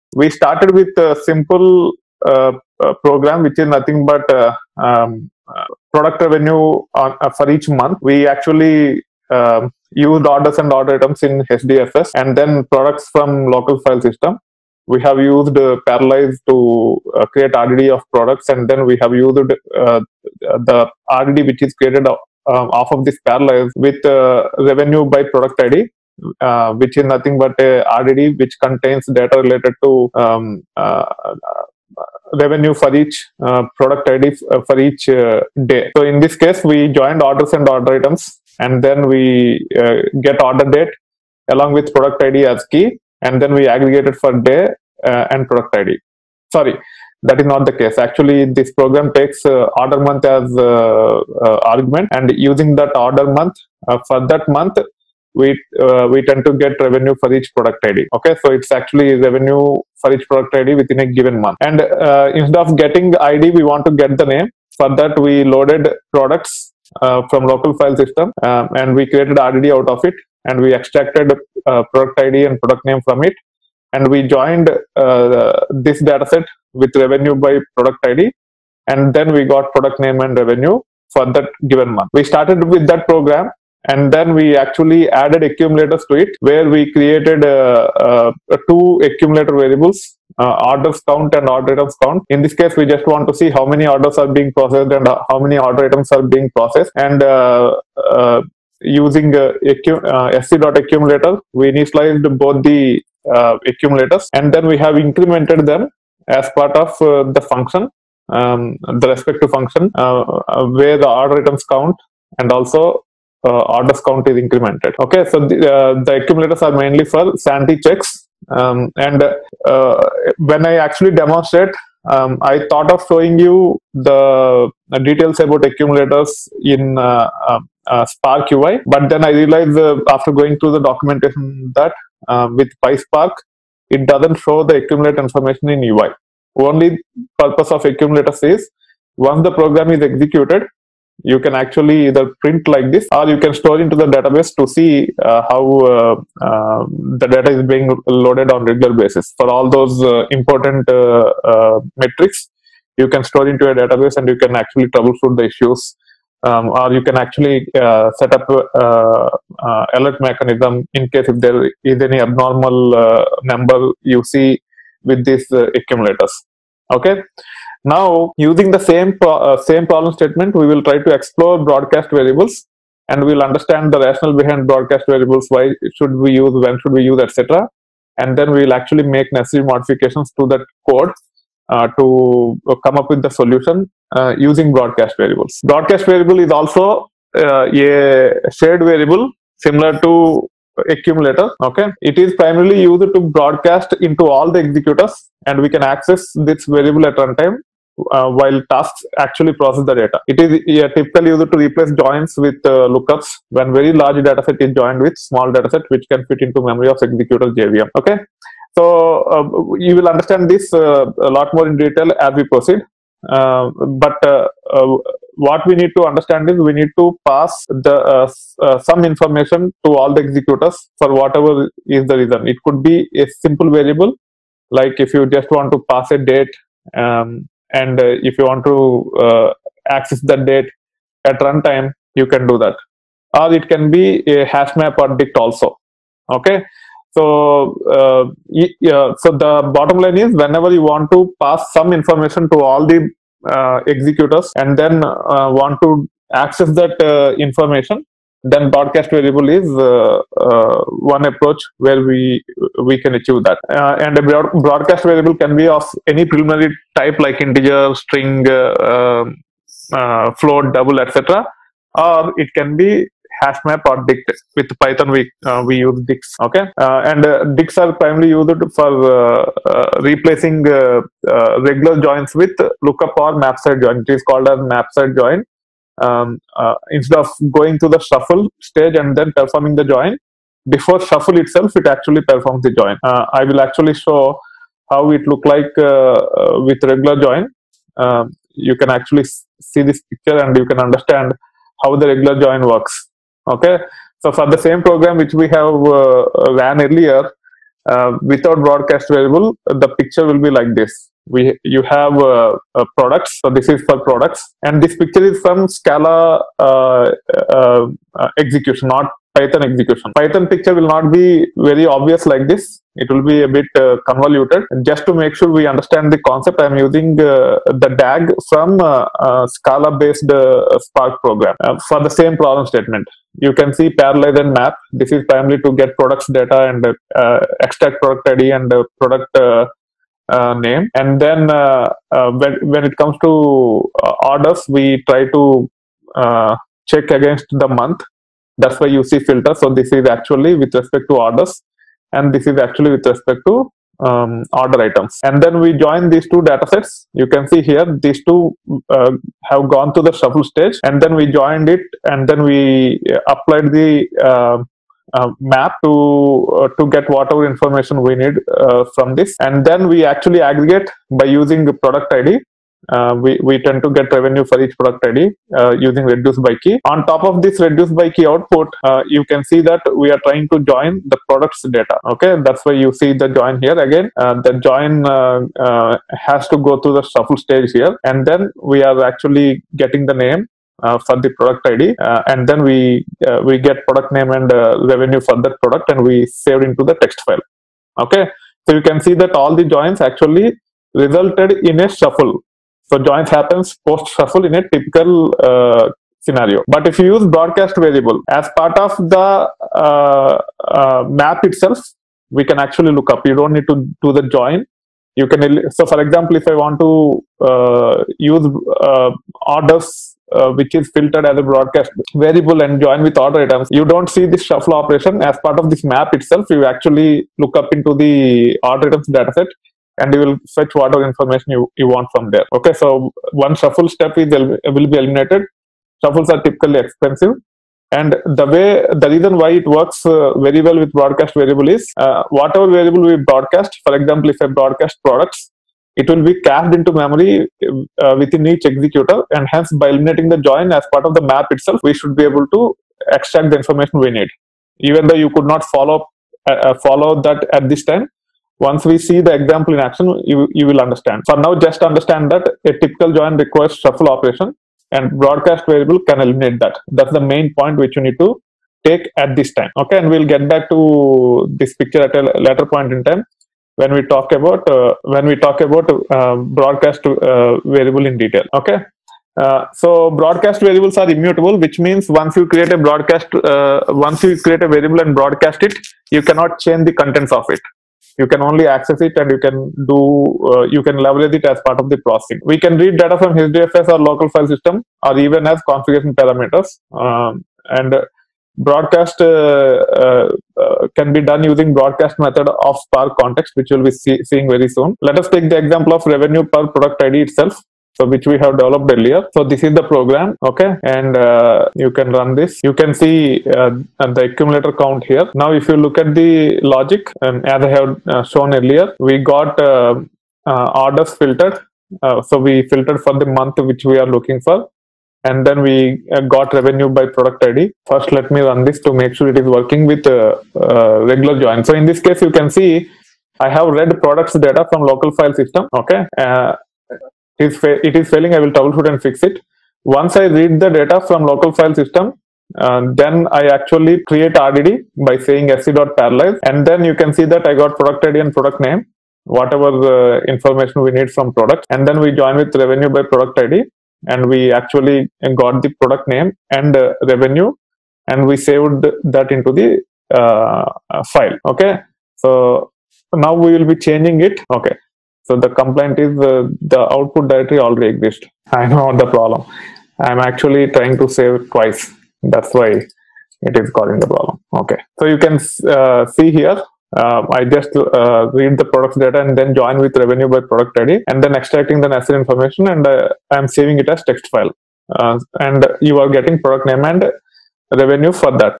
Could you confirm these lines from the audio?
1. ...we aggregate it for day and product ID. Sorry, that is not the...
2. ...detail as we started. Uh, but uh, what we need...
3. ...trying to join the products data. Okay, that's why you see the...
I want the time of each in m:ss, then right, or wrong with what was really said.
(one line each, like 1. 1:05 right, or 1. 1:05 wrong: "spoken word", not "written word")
1. 0:43 right
2. 3:31 wrong: "proceed", not "started"
3. 6:10 right.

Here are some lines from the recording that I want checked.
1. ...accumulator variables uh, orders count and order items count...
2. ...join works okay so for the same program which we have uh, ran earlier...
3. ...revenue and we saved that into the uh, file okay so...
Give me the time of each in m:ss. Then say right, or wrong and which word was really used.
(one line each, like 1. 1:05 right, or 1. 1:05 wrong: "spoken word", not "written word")
1. 1:29 right
2. 4:52 right
3. 9:07 right.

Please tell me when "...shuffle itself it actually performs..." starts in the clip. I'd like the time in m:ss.
4:40.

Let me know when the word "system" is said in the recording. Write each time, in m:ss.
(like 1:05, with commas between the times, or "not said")
0:14, 1:07, 8:04, 8:45, 8:51.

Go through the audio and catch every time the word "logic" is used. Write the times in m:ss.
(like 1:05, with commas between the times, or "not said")
8:26.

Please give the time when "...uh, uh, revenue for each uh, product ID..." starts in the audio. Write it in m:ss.
0:30.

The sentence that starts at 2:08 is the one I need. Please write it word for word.
But then I realized uh, after going through the documentation that uh, with PySpark, it doesn't show the accumulate information in UI.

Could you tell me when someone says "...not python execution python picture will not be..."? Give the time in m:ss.
5:08.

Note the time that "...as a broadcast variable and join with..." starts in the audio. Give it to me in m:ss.
6:51.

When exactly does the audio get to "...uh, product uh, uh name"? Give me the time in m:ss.
5:28.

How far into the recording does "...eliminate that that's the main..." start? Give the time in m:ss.
7:36.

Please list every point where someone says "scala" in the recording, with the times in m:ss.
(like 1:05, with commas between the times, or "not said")
5:05, 5:19.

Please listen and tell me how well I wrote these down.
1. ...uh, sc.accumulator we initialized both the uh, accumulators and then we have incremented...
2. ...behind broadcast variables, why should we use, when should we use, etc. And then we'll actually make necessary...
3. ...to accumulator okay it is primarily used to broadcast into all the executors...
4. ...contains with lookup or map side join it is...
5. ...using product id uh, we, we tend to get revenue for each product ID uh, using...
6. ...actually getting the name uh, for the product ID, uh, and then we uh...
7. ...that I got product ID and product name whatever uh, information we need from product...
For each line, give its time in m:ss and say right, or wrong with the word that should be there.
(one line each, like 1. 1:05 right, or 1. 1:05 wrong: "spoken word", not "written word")
1. 1:39 right
2. 2:54 right
3. 3:10 right
4. 4:32 wrong: "joins", not "contains"
5. 6:01 right
6. 6:19 right
7. 8:57 right.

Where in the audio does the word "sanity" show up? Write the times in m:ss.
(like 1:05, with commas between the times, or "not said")
1:57.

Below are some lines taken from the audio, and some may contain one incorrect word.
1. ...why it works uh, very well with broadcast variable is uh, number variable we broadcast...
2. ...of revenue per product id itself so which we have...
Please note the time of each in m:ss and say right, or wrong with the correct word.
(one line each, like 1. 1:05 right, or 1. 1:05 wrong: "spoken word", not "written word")
1. 7:09 wrong: "whatever", not "number"
2. 8:15 right.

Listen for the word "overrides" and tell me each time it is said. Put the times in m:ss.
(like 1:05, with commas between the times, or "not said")
not said.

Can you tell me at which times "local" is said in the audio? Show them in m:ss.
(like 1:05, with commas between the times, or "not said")
0:13, 1:07, 8:03, 8:44, 8:51.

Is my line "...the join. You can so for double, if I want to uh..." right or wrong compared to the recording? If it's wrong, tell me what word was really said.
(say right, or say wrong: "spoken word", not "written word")
wrong: "example", not "double".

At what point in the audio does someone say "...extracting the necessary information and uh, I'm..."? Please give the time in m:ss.
9:31.